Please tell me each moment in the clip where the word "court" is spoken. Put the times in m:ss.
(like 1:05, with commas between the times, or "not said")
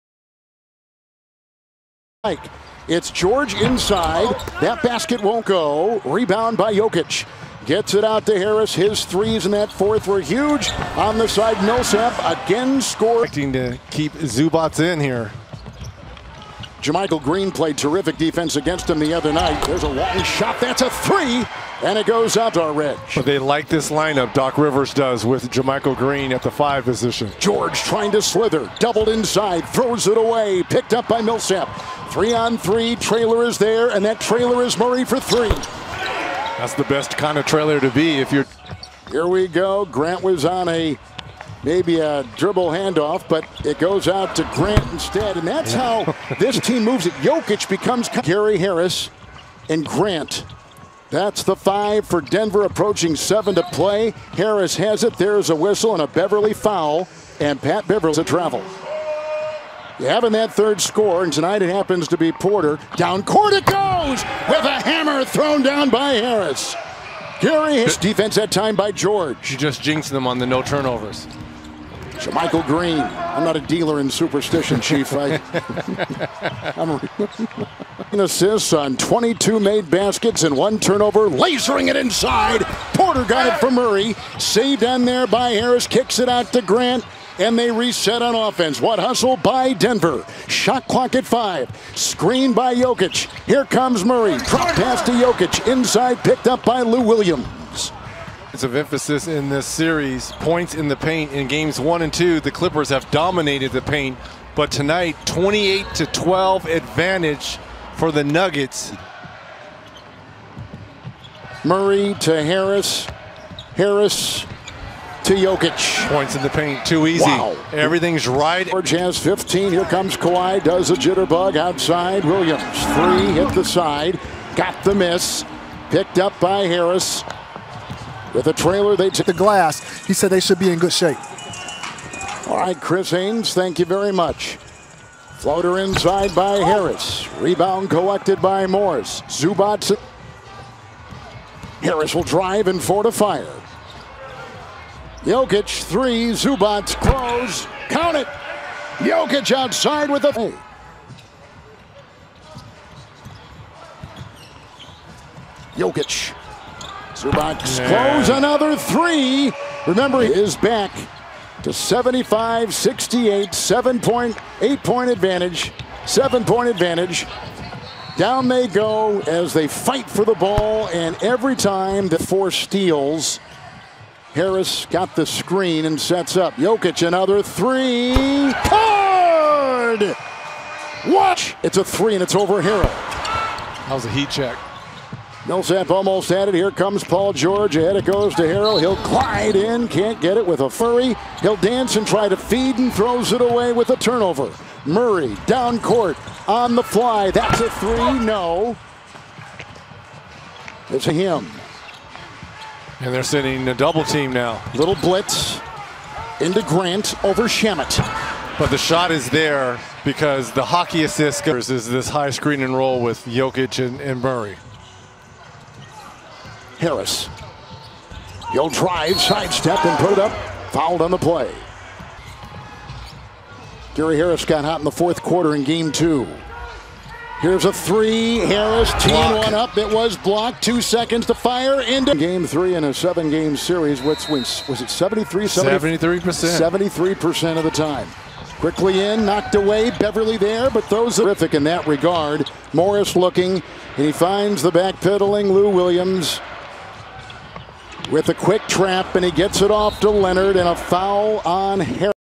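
1:03, 3:15.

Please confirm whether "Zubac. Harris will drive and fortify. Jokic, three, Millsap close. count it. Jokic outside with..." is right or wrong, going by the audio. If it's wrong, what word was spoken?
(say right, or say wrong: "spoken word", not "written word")
wrong: "Zubac", not "Millsap".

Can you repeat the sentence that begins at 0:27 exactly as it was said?
George trying to slither, doubled inside, throws it away, picked up by Millsap.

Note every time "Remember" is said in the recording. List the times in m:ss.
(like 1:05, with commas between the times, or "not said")
2:39.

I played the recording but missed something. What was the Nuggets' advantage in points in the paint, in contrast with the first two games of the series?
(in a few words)
28 to 12.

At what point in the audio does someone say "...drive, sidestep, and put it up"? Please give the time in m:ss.
3:38.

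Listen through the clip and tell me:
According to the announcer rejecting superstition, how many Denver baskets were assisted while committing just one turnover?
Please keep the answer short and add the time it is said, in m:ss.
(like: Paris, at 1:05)
22, at 1:18.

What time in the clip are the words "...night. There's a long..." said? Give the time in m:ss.
0:19.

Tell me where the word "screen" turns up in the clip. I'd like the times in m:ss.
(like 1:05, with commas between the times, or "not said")
1:31, 2:55, 3:32.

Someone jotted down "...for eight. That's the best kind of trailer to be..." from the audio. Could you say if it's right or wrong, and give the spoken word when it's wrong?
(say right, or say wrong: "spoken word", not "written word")
wrong: "three", not "eight".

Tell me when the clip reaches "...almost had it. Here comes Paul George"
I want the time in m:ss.
3:05.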